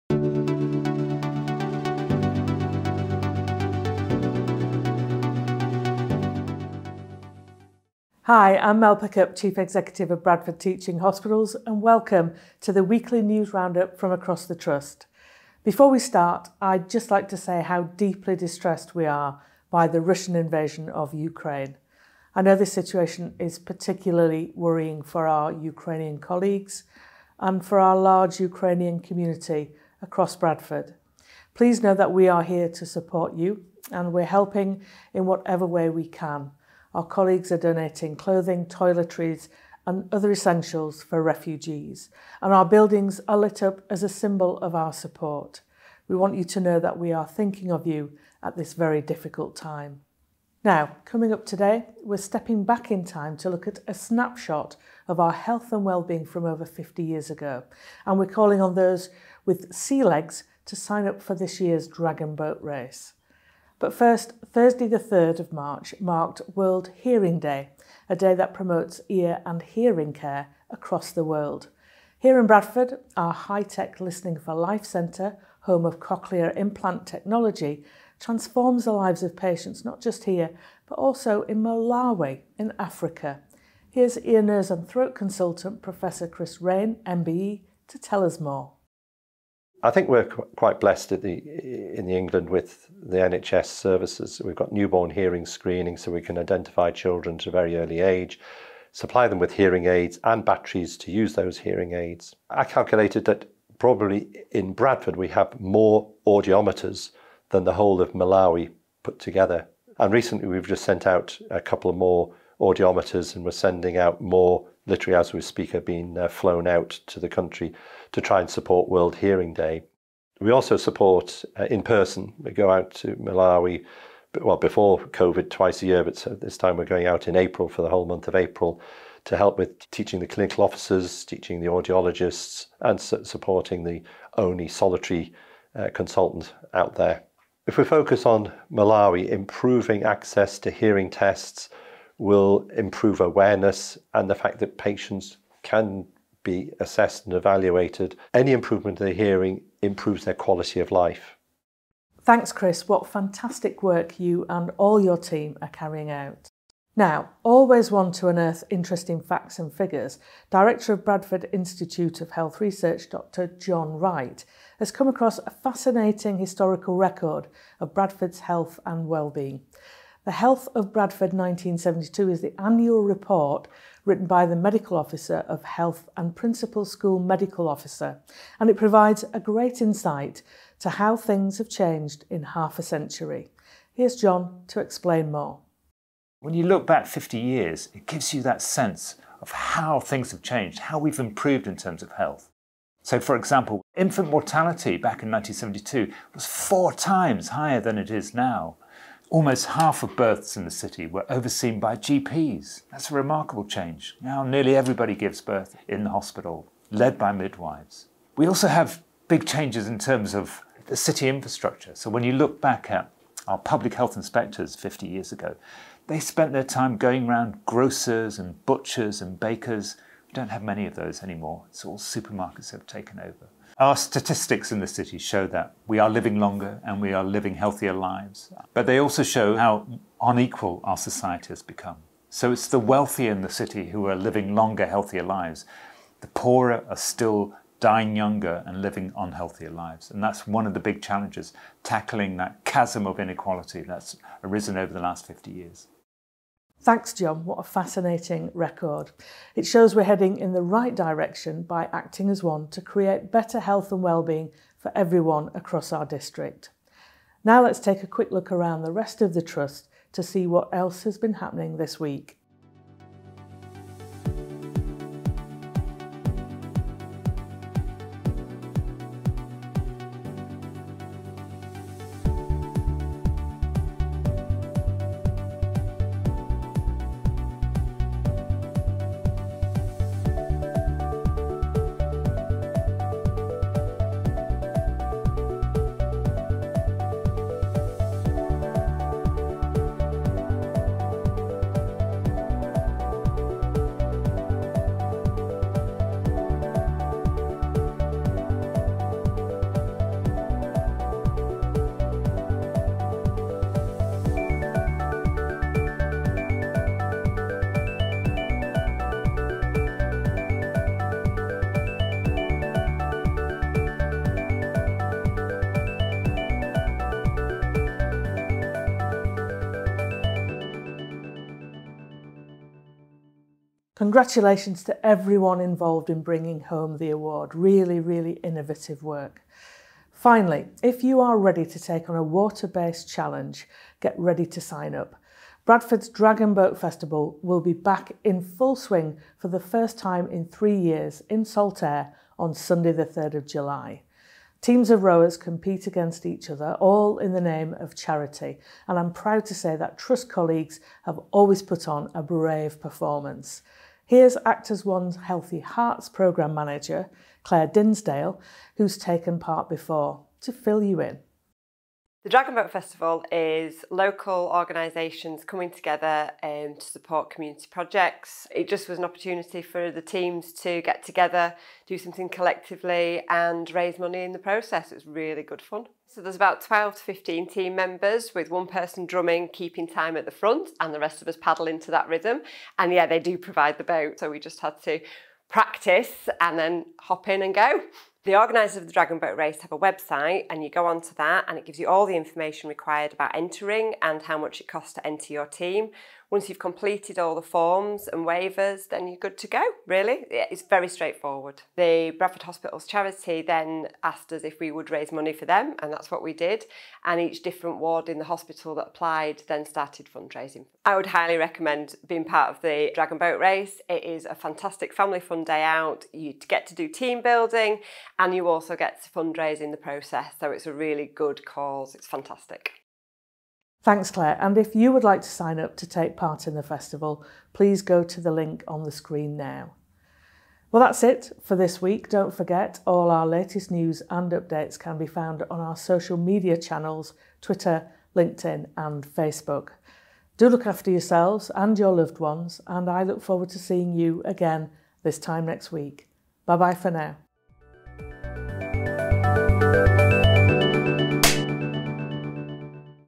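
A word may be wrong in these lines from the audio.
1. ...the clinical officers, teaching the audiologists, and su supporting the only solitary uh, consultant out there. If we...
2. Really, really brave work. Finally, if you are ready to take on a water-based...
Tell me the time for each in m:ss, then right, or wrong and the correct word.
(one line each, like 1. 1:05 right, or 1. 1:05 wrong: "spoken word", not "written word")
1. 2:10 right
2. 5:27 wrong: "innovative", not "brave".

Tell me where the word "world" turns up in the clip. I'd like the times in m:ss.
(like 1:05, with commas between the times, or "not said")
1:06, 1:11, 1:58.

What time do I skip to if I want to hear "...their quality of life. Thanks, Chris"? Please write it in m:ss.
2:30.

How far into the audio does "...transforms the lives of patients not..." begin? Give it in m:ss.
1:18.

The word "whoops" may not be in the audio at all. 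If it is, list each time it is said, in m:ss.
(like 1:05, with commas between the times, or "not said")
not said.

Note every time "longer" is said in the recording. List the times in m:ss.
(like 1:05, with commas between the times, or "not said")
3:46, 3:54.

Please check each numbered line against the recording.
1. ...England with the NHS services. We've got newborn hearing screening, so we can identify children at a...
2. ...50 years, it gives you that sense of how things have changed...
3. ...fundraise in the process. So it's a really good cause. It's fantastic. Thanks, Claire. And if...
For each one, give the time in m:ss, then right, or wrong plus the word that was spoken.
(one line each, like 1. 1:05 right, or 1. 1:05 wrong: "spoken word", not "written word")
1. 1:32 right
2. 3:07 right
3. 6:59 right.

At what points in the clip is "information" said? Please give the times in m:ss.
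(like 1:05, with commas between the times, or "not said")
6:32.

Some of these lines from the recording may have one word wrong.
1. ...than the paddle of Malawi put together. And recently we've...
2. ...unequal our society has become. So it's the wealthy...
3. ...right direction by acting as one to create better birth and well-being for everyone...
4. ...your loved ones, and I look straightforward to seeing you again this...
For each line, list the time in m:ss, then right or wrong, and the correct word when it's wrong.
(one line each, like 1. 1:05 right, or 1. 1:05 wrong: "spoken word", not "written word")
1. 1:47 wrong: "whole", not "paddle"
2. 3:50 right
3. 4:10 wrong: "health", not "birth"
4. 7:21 wrong: "forward", not "straightforward".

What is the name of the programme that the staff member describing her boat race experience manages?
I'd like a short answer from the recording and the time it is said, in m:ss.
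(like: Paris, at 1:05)
Healthy Hearts, at 5:55.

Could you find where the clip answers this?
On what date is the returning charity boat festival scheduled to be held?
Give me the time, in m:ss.
5:42.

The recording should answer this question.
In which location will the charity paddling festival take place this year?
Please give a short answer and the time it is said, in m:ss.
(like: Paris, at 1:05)
Saltaire, at 5:41.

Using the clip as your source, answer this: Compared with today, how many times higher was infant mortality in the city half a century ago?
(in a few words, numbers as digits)
four times.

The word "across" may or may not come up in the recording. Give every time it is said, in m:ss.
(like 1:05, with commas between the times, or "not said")
0:14, 0:30, 1:10, 2:45, 4:15.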